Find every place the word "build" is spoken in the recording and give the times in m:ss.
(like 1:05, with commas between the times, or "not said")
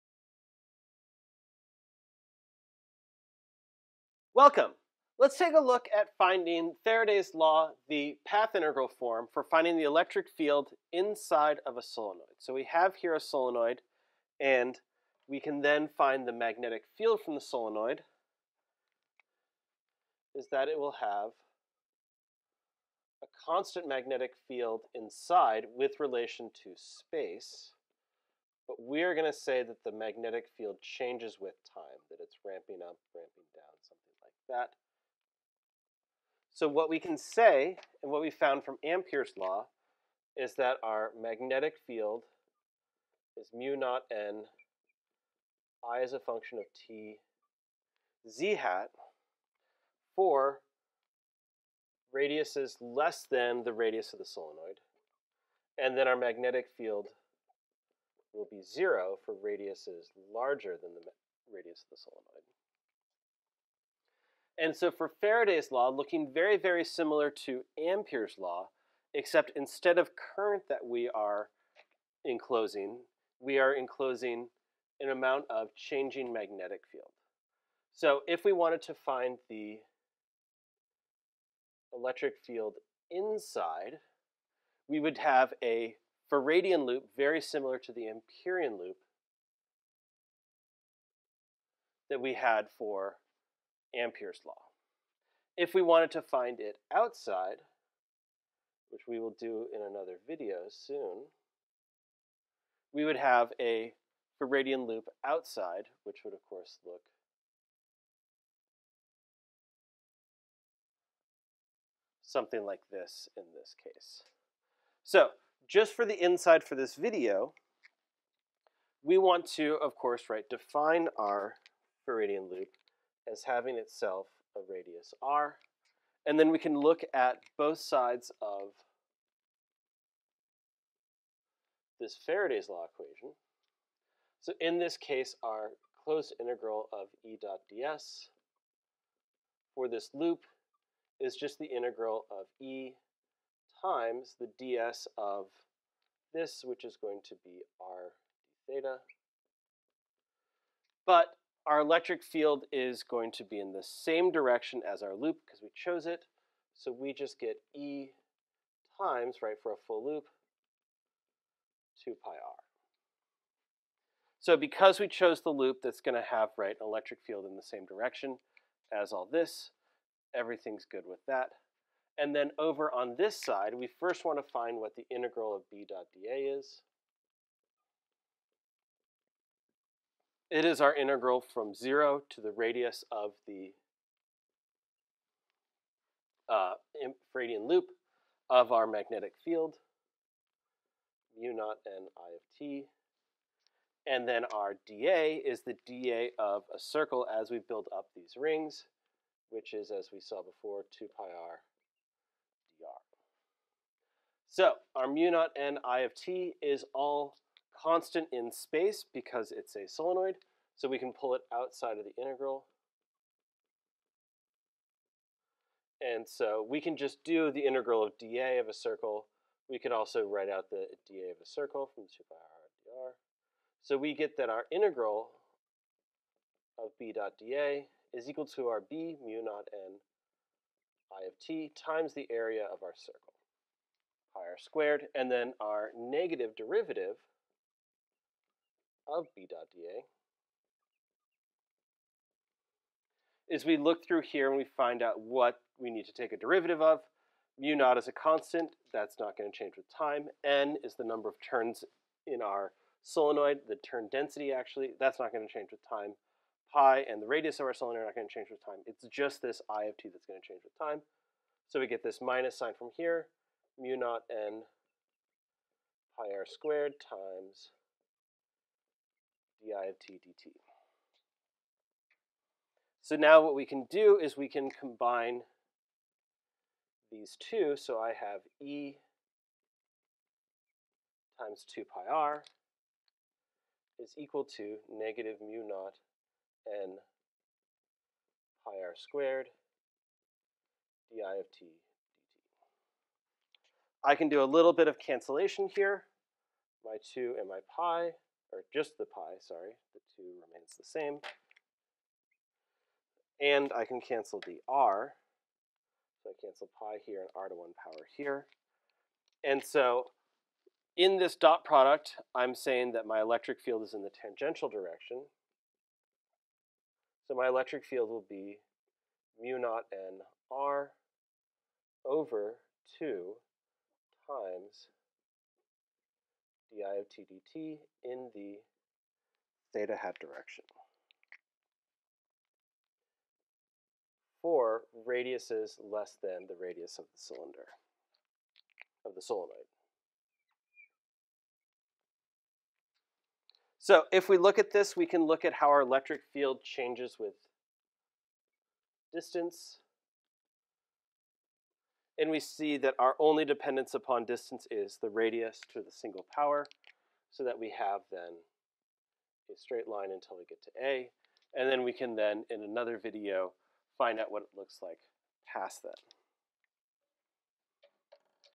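3:17.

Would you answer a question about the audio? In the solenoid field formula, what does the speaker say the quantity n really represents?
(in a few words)
turn density.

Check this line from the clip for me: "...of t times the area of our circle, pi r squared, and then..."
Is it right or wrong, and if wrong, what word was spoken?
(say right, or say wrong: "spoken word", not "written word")
right.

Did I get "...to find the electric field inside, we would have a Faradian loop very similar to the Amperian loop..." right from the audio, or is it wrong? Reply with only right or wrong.
right.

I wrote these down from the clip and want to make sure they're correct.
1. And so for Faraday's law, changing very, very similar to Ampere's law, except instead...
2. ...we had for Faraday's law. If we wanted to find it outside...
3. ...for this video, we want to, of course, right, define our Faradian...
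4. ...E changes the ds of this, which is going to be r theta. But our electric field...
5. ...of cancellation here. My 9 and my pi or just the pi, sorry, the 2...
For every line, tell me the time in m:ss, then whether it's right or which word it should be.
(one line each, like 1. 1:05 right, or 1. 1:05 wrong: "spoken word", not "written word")
1. 1:04 wrong: "looking", not "changing"
2. 1:32 wrong: "Ampere", not "Faraday"
3. 1:56 right
4. 2:22 wrong: "times", not "changes"
5. 4:54 wrong: "2", not "9".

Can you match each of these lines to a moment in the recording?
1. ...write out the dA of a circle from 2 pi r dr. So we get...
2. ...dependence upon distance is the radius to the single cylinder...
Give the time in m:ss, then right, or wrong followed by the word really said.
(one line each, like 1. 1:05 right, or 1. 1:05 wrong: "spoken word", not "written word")
1. 3:40 right
2. 5:53 wrong: "power", not "cylinder".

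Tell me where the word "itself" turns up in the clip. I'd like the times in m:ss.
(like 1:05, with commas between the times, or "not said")
2:03.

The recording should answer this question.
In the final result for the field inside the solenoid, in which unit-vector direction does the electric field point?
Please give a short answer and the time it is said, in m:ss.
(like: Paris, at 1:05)
theta hat, at 5:29.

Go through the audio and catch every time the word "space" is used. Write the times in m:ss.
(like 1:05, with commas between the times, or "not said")
0:26, 3:28.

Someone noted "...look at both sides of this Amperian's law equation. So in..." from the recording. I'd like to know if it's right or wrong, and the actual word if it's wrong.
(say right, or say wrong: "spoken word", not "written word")
wrong: "Faraday", not "Amperian".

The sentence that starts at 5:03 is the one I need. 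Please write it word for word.
And I can cancel the r, so I cancel pi here and r to 1 power here.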